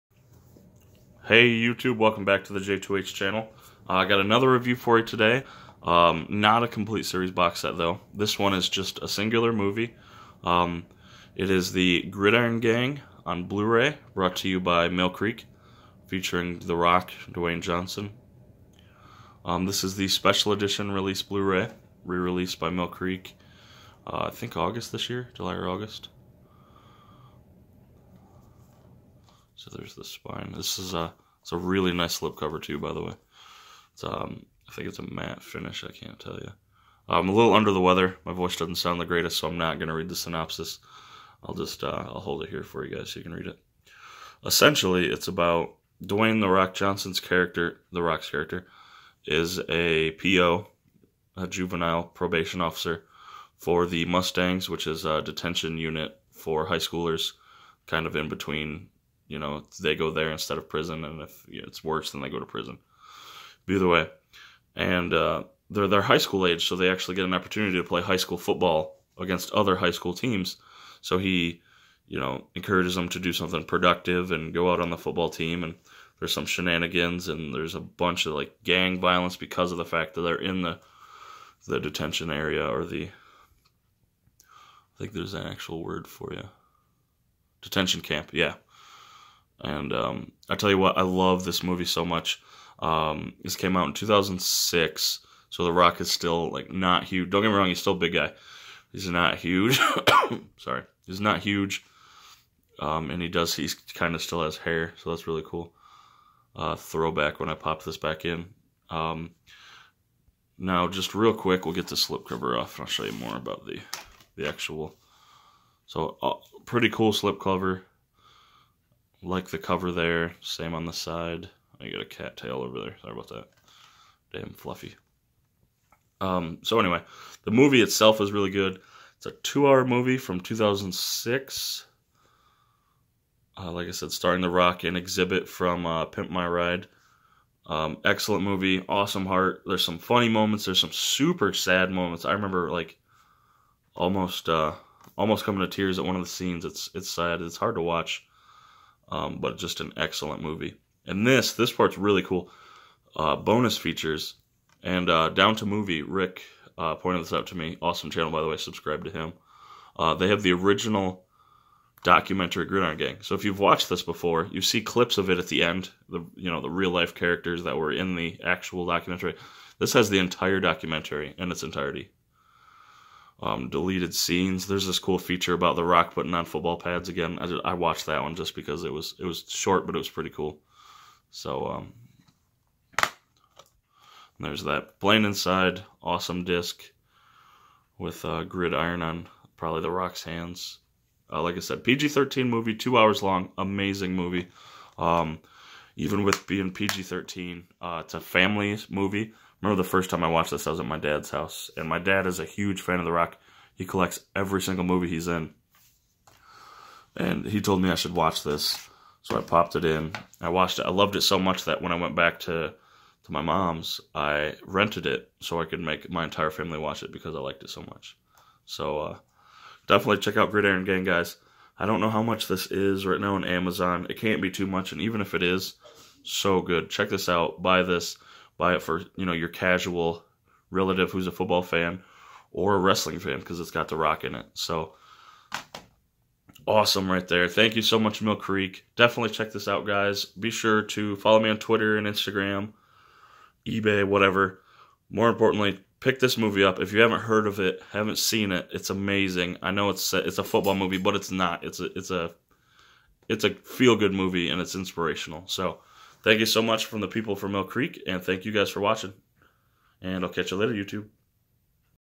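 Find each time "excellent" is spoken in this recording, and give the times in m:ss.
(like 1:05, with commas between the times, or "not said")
2:18, 2:29.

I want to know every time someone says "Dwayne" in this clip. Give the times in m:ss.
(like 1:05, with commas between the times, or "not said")
0:17, 0:46.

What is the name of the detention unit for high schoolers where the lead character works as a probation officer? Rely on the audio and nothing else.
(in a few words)
Mustangs.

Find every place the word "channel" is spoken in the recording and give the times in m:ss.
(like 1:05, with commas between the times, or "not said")
0:03, 2:38.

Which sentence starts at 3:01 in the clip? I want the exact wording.
So um, there's that plain inside, awesome disc with uh, gridiron on probably The Rock's hands.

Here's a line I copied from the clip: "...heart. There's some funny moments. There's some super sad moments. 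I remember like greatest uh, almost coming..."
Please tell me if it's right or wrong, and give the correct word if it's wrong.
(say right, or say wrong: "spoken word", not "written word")
wrong: "almost", not "greatest".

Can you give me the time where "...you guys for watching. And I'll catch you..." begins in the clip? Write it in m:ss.
4:18.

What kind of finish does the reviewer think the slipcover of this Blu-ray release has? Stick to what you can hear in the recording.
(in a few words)
Matte.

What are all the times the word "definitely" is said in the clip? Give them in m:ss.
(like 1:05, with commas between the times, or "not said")
3:39, 3:58.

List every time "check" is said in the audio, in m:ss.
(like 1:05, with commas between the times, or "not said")
3:40, 3:46, 3:59.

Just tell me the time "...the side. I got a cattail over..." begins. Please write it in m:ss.
2:00.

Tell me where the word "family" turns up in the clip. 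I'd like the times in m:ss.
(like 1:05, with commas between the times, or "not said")
3:18, 3:36.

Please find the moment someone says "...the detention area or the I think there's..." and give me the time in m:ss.
1:21.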